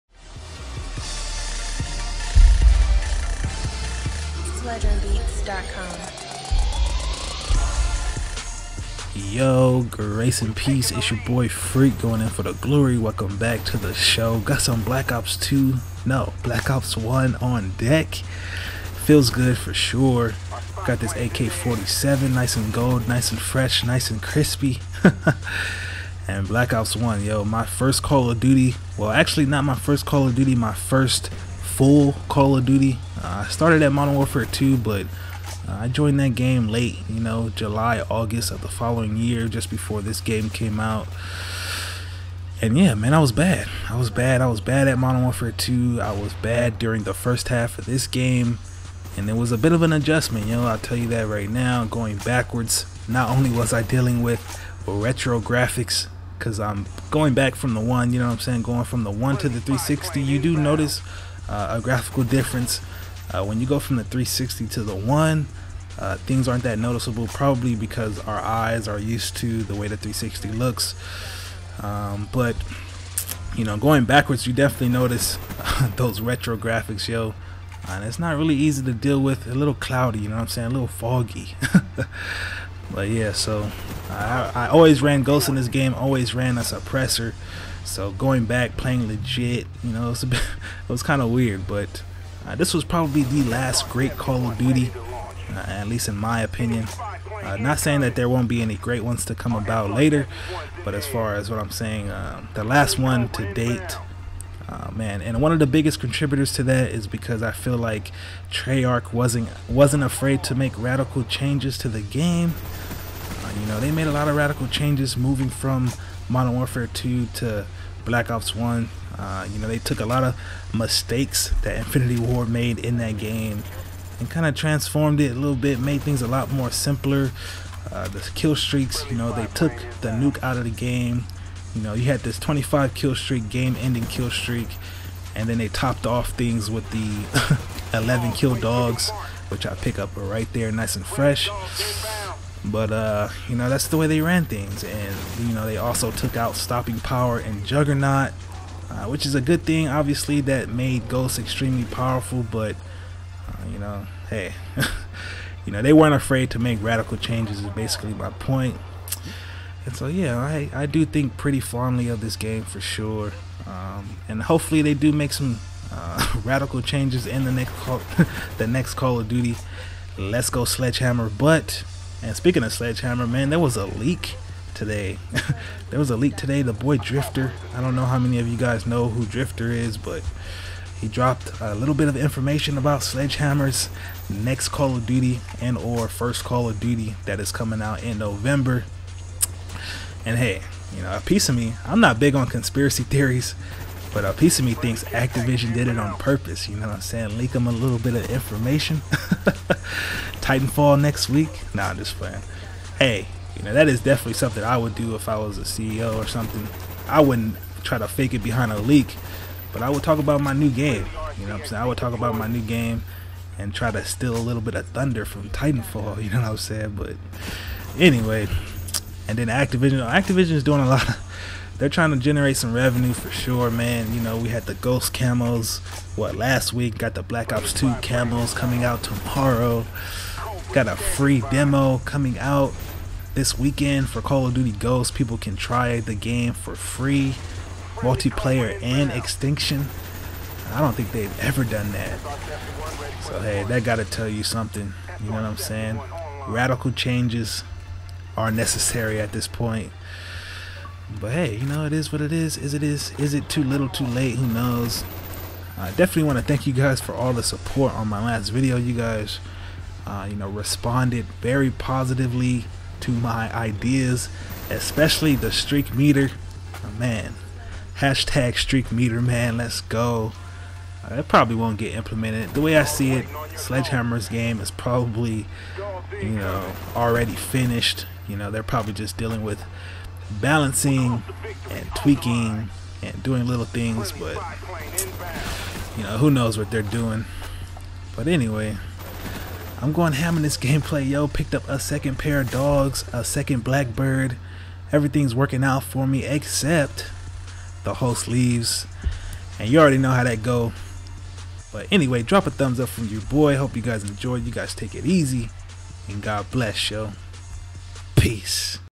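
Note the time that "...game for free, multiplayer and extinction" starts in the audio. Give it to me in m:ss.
3:56.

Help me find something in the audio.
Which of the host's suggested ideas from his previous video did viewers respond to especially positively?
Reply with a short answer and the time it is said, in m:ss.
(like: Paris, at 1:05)
the streak meter, at 4:25.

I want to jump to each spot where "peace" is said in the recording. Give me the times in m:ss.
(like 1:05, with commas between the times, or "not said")
0:10, 5:08.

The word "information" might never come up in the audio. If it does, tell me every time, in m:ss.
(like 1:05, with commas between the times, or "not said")
3:02, 3:18.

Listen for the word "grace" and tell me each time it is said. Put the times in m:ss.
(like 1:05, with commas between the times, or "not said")
0:09.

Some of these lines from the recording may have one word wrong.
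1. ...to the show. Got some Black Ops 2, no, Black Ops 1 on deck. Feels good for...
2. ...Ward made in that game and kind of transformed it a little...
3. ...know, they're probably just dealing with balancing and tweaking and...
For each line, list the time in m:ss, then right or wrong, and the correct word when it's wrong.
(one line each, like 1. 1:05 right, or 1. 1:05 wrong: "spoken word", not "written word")
1. 0:13 right
2. 2:02 right
3. 4:38 right.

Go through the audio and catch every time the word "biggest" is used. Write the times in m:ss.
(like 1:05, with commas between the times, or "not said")
1:45.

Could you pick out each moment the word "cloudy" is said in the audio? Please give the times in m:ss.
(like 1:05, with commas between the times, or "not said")
1:19.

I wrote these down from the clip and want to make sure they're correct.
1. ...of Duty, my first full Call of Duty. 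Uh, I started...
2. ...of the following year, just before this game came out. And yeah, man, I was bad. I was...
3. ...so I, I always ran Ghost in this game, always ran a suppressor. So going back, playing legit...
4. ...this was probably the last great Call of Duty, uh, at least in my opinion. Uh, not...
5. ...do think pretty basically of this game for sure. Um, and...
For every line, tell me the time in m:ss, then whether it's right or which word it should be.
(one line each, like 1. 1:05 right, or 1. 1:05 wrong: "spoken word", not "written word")
1. 0:30 right
2. 0:38 right
3. 1:23 right
4. 1:32 right
5. 2:40 wrong: "fondly", not "basically".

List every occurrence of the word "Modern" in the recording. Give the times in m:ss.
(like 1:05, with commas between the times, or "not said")
0:33, 0:44, 1:56.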